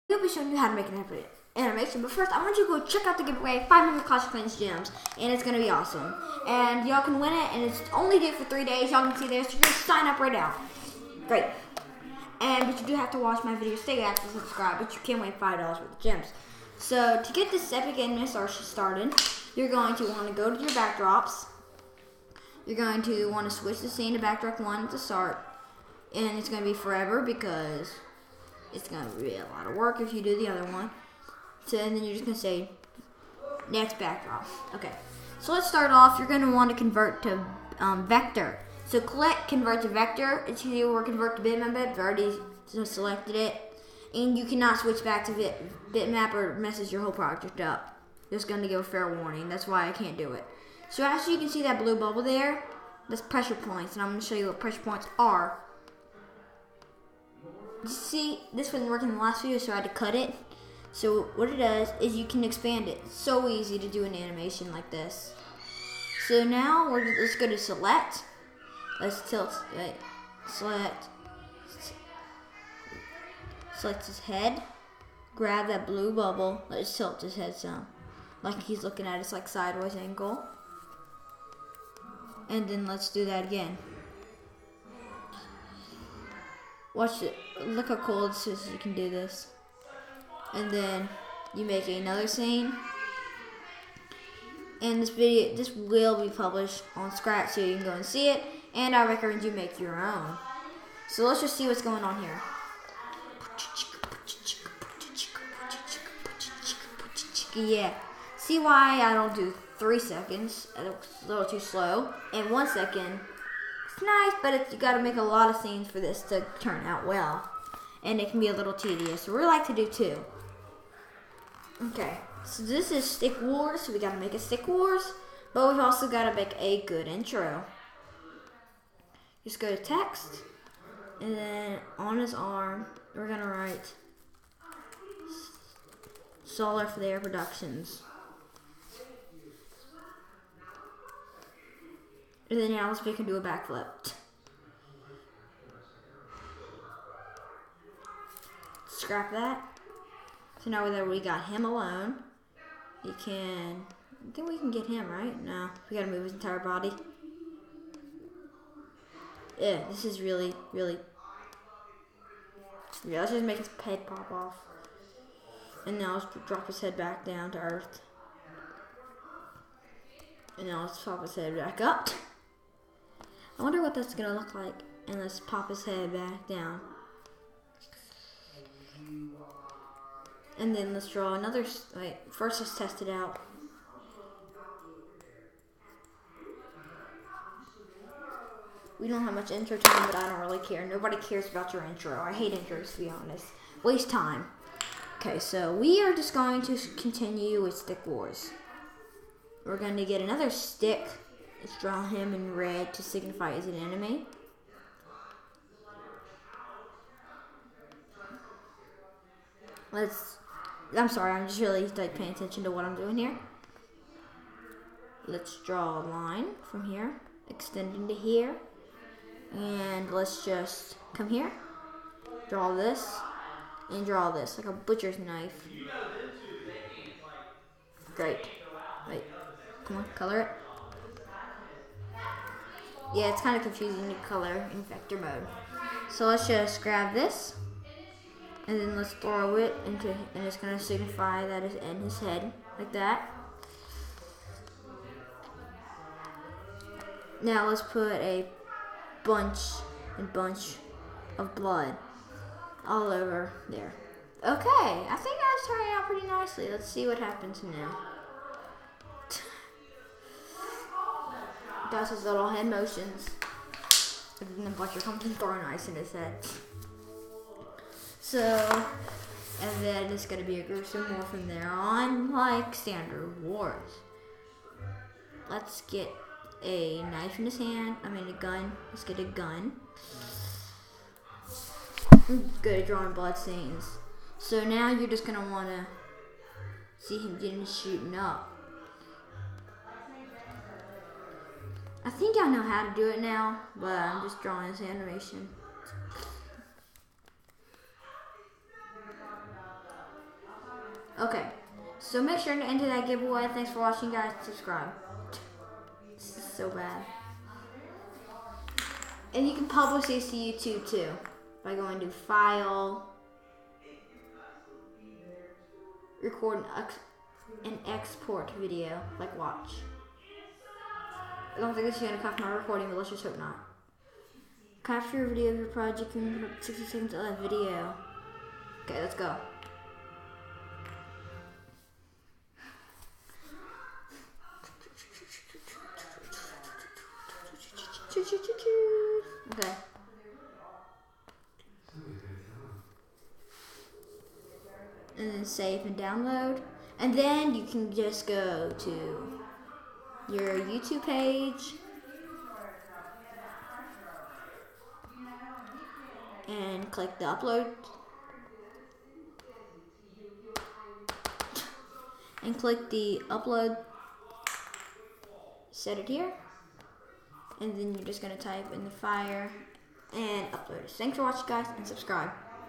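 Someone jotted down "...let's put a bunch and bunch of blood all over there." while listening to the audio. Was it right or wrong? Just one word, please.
right.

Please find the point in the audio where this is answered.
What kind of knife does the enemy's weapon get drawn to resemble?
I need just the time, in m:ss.
3:44.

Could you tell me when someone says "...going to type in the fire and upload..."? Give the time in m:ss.
6:08.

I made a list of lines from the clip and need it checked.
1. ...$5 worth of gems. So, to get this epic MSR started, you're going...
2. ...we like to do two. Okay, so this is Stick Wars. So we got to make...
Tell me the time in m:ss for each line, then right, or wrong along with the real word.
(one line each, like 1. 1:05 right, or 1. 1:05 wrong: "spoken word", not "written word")
1. 0:15 right
2. 1:59 right.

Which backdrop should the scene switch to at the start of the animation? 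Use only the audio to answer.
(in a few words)
backdrop 1.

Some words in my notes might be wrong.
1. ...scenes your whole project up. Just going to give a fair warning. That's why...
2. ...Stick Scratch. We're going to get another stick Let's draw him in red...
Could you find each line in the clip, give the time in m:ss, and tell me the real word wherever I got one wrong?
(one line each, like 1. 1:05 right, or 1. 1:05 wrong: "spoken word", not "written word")
1. 0:46 wrong: "messes", not "scenes"
2. 3:17 wrong: "Wars", not "Scratch".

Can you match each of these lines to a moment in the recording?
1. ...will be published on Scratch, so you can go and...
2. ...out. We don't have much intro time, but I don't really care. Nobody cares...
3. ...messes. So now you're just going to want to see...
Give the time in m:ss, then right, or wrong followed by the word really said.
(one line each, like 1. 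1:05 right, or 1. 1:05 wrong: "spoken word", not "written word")
1. 1:35 right
2. 3:03 right
3. 4:43 wrong: "scenes", not "messes".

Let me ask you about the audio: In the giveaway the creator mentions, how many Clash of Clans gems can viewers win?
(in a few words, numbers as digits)
500.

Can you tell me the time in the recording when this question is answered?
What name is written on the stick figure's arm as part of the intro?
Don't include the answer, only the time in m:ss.
2:16.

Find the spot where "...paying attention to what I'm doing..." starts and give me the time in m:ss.
3:32.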